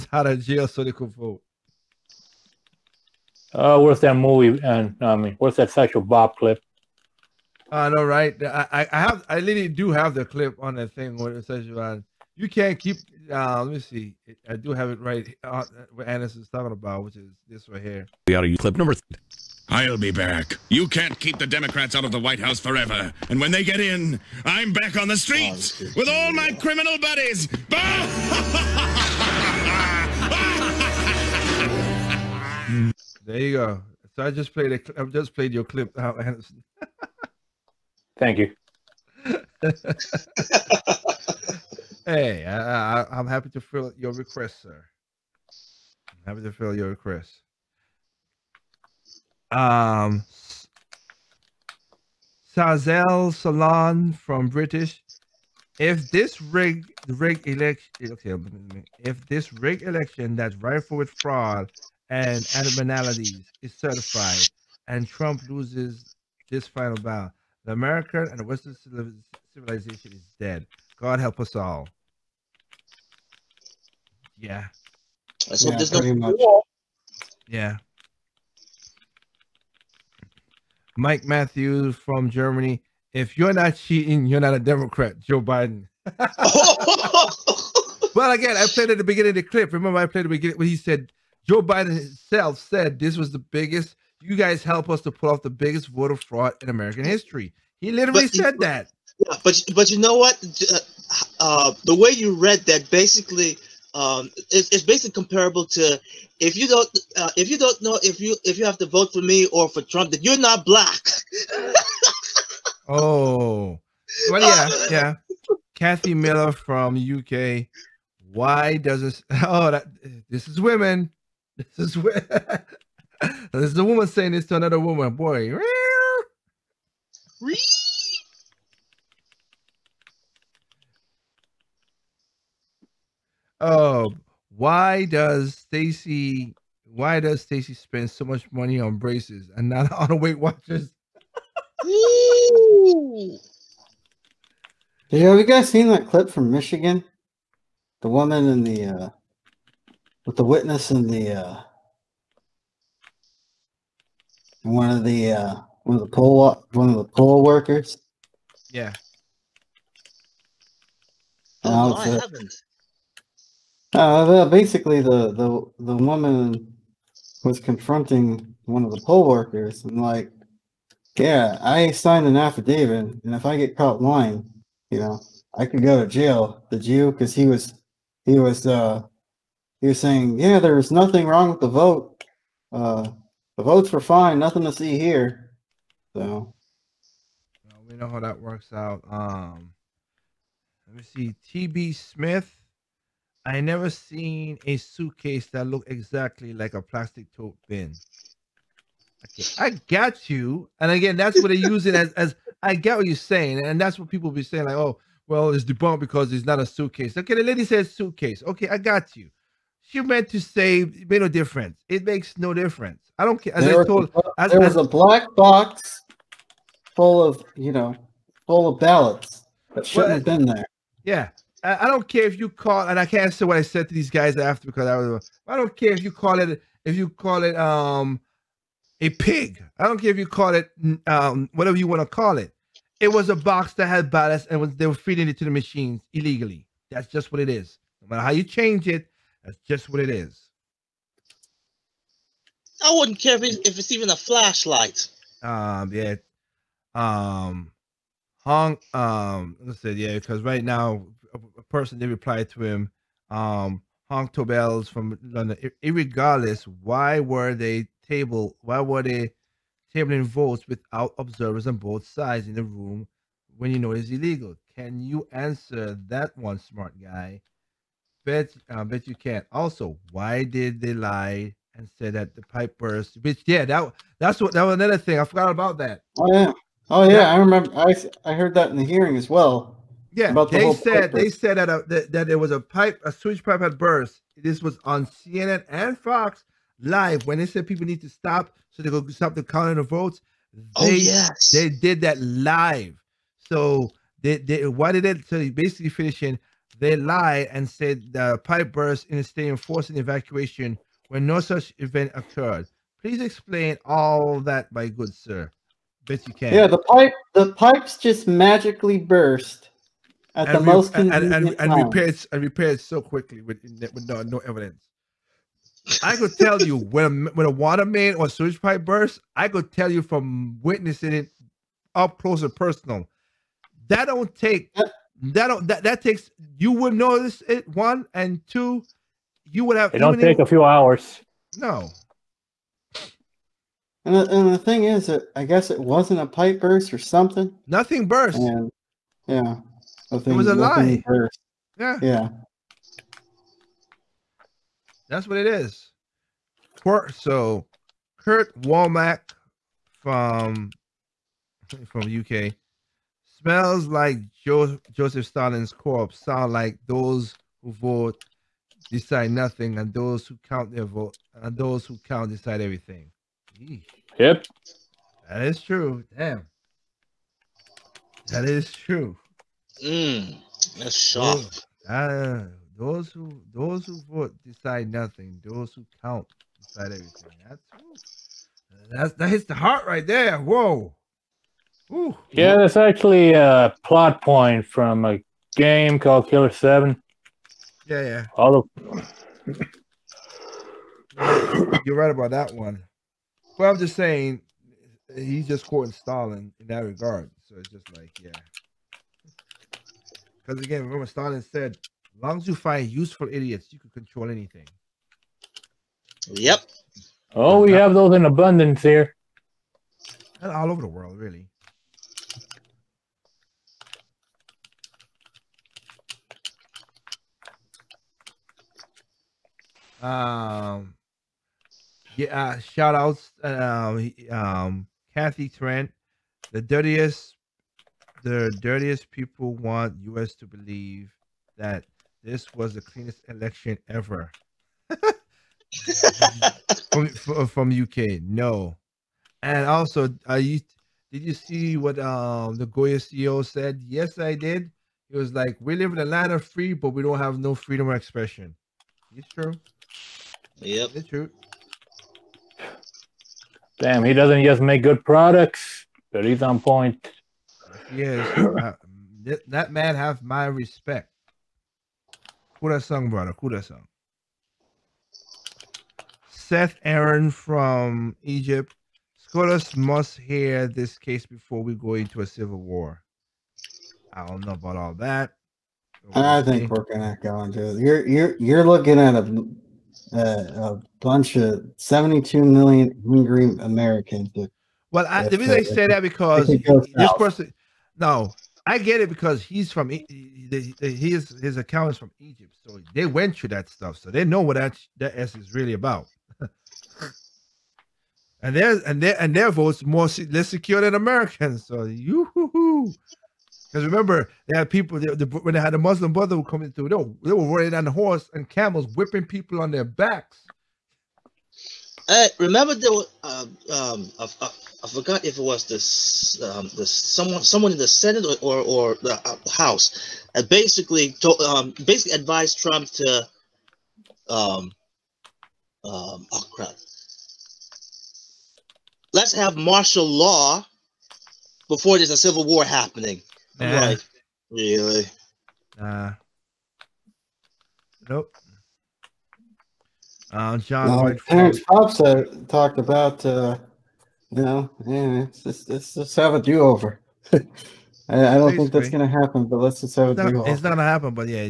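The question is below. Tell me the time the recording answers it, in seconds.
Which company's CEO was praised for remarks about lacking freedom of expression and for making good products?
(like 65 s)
442 s.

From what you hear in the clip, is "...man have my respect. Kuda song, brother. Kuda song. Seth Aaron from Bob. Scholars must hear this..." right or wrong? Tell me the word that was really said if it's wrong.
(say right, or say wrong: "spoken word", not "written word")
wrong: "Egypt", not "Bob".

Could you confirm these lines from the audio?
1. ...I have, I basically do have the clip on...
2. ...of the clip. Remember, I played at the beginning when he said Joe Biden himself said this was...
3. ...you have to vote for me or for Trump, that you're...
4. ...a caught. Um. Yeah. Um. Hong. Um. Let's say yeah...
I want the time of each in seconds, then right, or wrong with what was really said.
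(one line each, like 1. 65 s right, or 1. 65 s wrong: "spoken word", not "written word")
1. 8 s wrong: "literally", not "basically"
2. 89 s right
3. 108 s right
4. 244 s wrong: "flashlight", not "caught".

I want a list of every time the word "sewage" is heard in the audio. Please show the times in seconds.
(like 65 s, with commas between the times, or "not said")
283 s, 318 s.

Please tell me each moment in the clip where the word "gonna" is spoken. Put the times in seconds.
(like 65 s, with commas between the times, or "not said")
476 s.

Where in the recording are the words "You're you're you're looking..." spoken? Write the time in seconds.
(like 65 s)
477 s.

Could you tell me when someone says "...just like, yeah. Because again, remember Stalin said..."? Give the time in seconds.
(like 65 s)
397 s.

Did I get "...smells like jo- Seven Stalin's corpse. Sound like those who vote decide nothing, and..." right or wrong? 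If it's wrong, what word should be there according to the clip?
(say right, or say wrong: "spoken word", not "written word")
wrong: "Joseph", not "Seven".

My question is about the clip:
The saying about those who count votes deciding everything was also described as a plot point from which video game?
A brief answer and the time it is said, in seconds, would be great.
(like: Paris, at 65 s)
Killer Seven, at 386 s.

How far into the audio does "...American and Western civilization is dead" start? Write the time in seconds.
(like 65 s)
67 s.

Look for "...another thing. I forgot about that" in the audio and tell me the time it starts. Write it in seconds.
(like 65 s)
274 s.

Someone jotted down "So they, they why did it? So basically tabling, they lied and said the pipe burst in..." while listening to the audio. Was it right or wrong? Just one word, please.
wrong.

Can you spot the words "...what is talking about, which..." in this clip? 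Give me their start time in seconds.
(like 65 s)
15 s.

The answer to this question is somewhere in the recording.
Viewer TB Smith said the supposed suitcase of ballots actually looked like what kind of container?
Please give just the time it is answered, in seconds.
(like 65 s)
196 s.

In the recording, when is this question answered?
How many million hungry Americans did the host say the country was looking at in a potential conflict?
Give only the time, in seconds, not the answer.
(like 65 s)
481 s.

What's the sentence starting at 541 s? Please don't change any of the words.
Terrence uh, talked about, uh, you know, yeah, it's just, let's just have a do over.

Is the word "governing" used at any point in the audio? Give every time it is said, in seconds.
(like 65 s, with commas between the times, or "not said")
not said.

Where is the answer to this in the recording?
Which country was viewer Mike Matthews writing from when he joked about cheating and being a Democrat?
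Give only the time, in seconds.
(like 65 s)
82 s.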